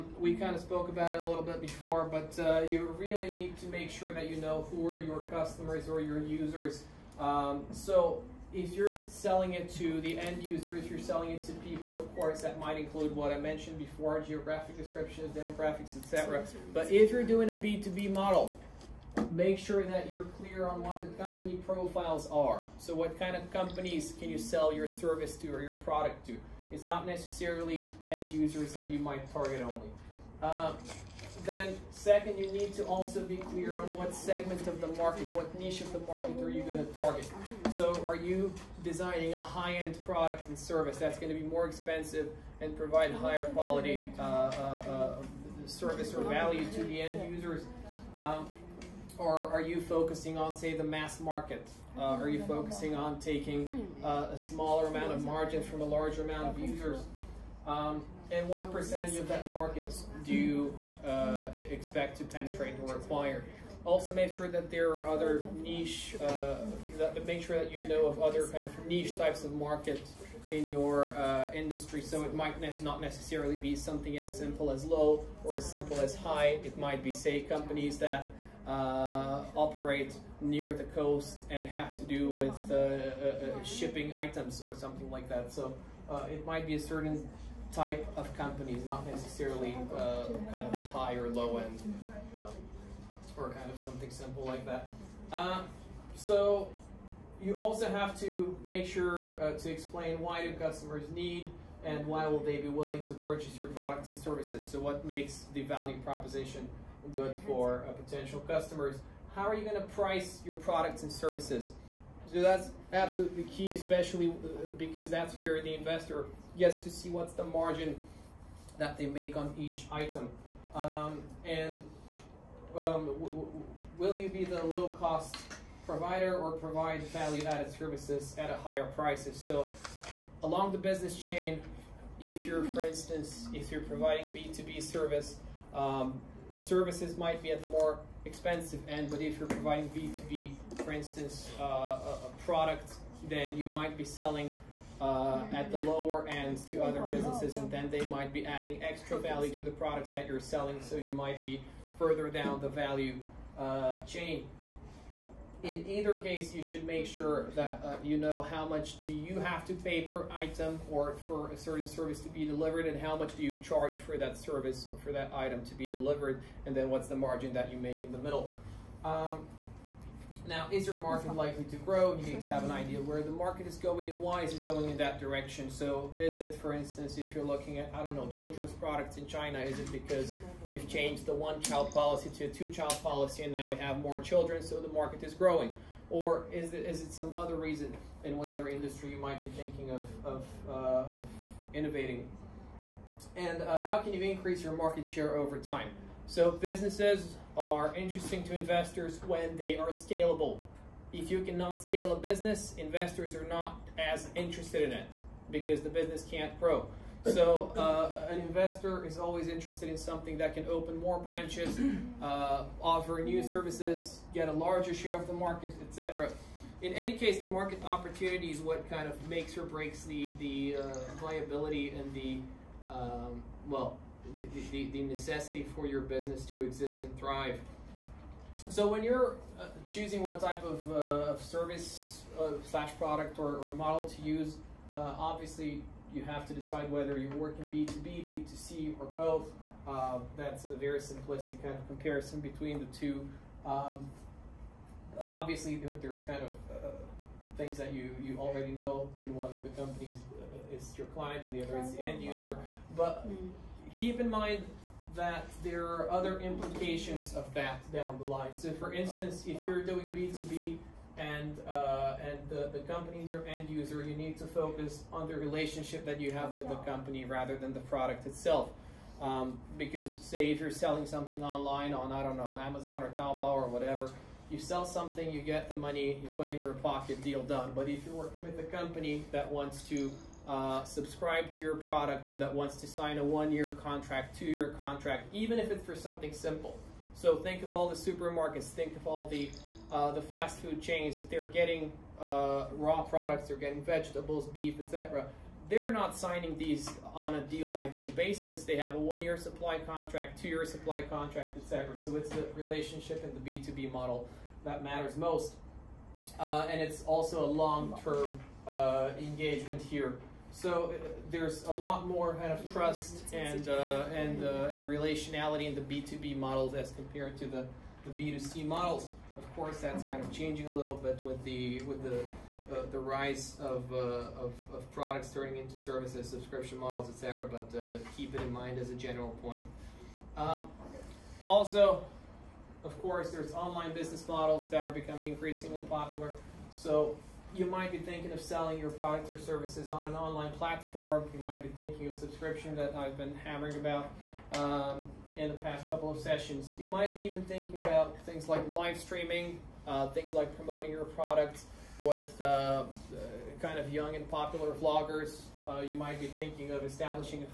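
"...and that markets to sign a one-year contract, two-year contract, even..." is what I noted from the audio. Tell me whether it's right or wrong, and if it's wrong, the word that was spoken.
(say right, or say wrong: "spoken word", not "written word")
wrong: "wants", not "markets".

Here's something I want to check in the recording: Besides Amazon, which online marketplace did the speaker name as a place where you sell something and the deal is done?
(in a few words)
Taobao.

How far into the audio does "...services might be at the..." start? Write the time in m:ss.
2:16.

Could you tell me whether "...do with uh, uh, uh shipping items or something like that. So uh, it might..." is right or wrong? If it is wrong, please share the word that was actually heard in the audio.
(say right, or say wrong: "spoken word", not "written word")
right.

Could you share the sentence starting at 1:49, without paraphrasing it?
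How are you going to price your products and services?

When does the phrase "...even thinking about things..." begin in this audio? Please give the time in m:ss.
5:47.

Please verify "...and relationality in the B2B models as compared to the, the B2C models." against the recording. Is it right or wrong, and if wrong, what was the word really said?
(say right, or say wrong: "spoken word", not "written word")
right.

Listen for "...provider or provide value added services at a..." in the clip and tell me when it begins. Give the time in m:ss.
2:05.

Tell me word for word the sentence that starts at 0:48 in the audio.
Um, or are you focusing on, say, the mass market?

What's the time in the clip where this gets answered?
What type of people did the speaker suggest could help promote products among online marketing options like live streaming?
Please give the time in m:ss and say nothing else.
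5:53.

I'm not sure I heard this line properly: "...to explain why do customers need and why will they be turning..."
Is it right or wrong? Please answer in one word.
wrong.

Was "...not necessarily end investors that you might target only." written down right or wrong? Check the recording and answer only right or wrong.
wrong.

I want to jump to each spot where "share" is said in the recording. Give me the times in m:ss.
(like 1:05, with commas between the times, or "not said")
3:15, 3:34.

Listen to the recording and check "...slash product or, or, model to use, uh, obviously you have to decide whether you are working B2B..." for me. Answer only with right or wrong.
right.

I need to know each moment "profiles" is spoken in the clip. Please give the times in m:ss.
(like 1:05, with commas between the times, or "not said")
0:21.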